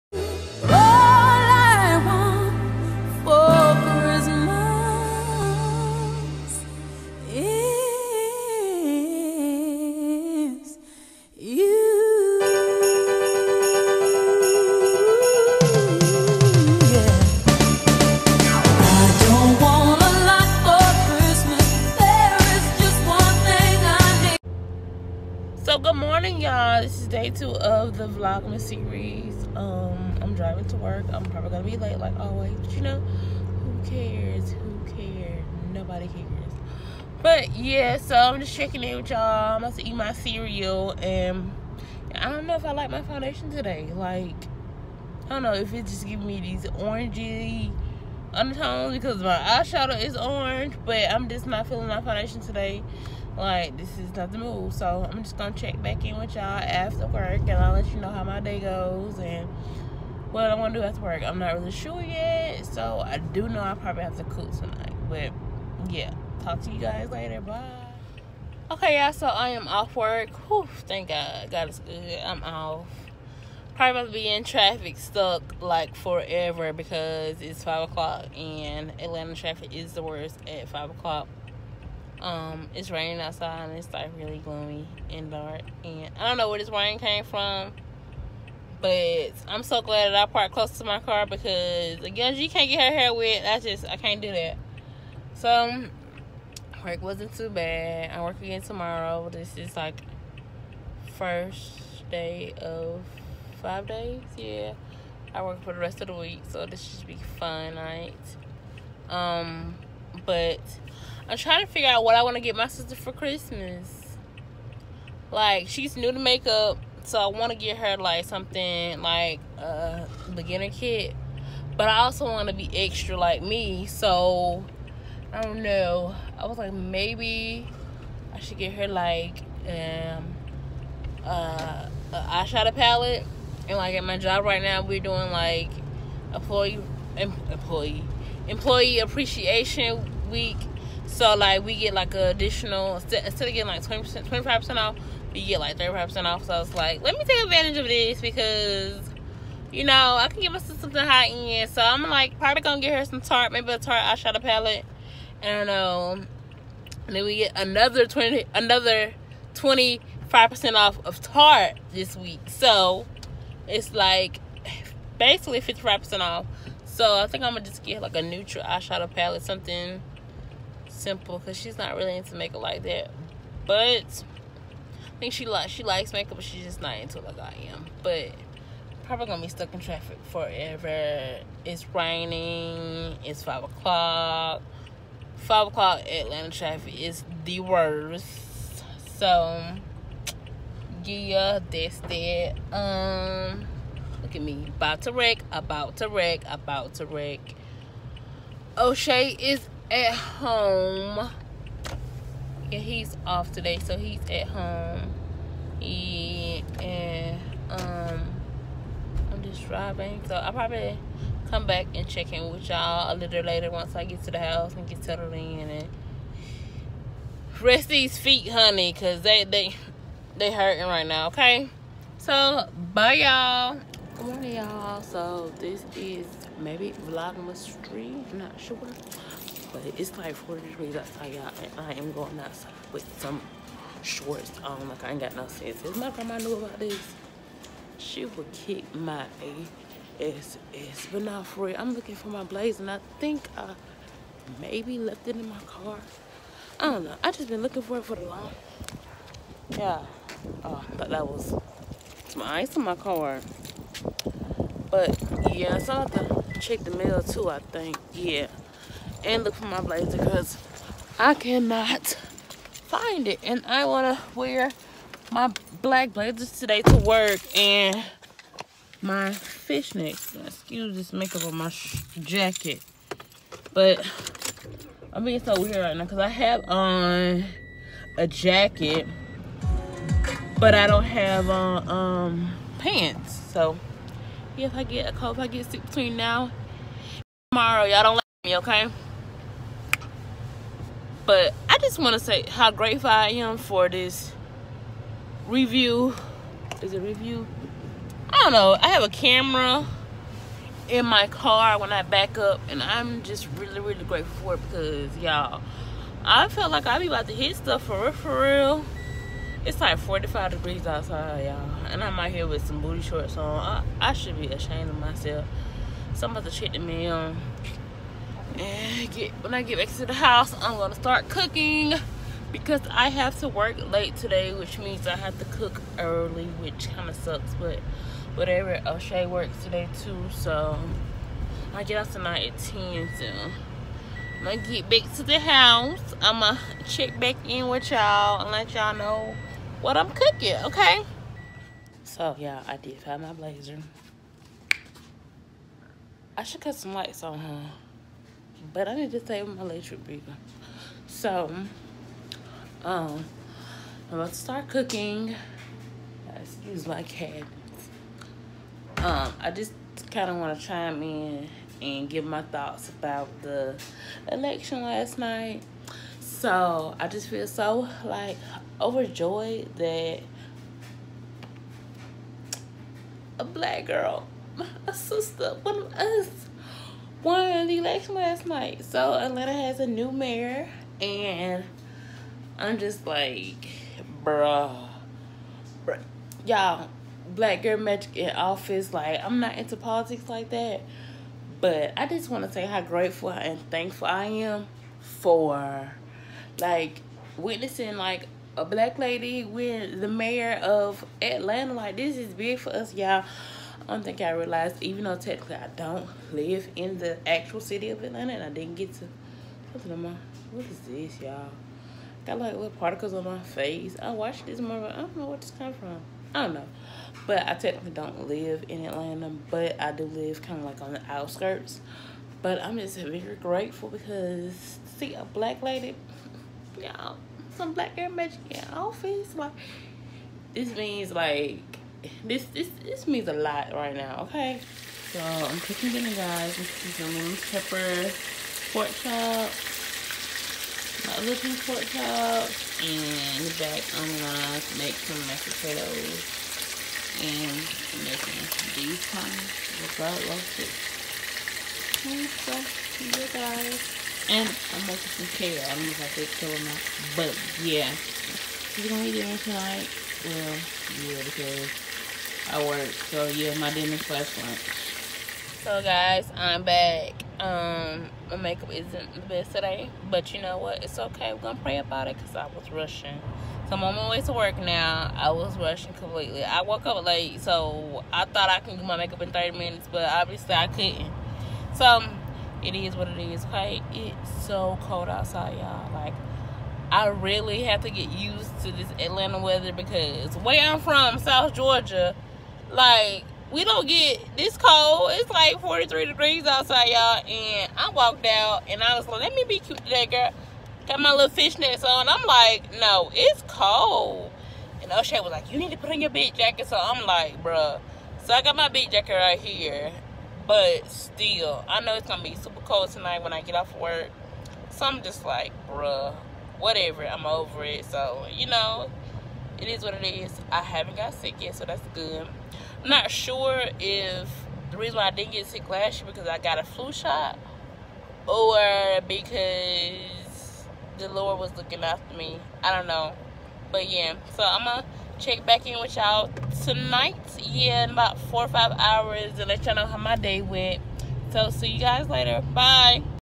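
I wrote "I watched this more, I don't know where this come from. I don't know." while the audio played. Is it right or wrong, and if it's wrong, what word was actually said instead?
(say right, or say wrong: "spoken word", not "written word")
right.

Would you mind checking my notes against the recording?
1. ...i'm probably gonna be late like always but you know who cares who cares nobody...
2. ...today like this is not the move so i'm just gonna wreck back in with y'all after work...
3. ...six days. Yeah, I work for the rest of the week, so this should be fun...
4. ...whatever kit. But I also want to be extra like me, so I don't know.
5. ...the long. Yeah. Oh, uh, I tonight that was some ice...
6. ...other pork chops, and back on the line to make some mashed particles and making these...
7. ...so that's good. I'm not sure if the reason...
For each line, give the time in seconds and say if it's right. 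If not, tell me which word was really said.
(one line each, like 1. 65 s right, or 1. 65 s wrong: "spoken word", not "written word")
1. 31 s right
2. 52 s wrong: "check", not "wreck"
3. 103 s wrong: "five", not "six"
4. 120 s wrong: "beginner", not "whatever"
5. 248 s wrong: "thought", not "tonight"
6. 441 s wrong: "potatoes", not "particles"
7. 521 s right.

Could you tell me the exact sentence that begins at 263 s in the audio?
And I want to wear my black blazers today to work and my fishnets.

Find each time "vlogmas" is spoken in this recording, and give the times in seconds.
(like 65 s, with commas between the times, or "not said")
28 s, 227 s.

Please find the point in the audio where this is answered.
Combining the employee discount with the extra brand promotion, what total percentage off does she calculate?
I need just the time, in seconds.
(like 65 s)
165 s.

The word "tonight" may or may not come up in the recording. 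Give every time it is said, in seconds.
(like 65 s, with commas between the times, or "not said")
64 s, 332 s, 459 s, 512 s, 536 s.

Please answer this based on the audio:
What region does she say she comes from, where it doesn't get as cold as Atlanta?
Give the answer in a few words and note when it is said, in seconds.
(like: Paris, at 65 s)
South Georgia, at 491 s.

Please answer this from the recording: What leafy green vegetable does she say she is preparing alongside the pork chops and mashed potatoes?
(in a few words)
kale.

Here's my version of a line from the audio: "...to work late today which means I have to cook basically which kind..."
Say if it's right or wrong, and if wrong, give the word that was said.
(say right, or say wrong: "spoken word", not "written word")
wrong: "early", not "basically".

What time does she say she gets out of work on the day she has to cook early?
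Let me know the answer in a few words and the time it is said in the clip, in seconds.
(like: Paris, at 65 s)
10, at 332 s.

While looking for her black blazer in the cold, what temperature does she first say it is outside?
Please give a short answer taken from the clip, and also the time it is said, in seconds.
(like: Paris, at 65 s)
40 degrees, at 230 s.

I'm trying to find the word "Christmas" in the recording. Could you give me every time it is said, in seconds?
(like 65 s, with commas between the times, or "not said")
113 s.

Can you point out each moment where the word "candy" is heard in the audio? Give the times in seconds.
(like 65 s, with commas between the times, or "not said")
not said.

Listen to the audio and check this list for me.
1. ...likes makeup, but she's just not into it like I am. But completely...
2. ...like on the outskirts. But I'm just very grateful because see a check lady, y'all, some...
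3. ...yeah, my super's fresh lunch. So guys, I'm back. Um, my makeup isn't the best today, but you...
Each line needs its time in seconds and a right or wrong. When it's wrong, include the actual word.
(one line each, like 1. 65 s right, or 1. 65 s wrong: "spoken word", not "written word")
1. 175 s wrong: "probably", not "completely"
2. 420 s wrong: "black", not "check"
3. 463 s wrong: "dinner", not "super".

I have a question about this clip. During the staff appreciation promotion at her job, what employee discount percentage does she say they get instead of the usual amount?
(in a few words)
35 percent.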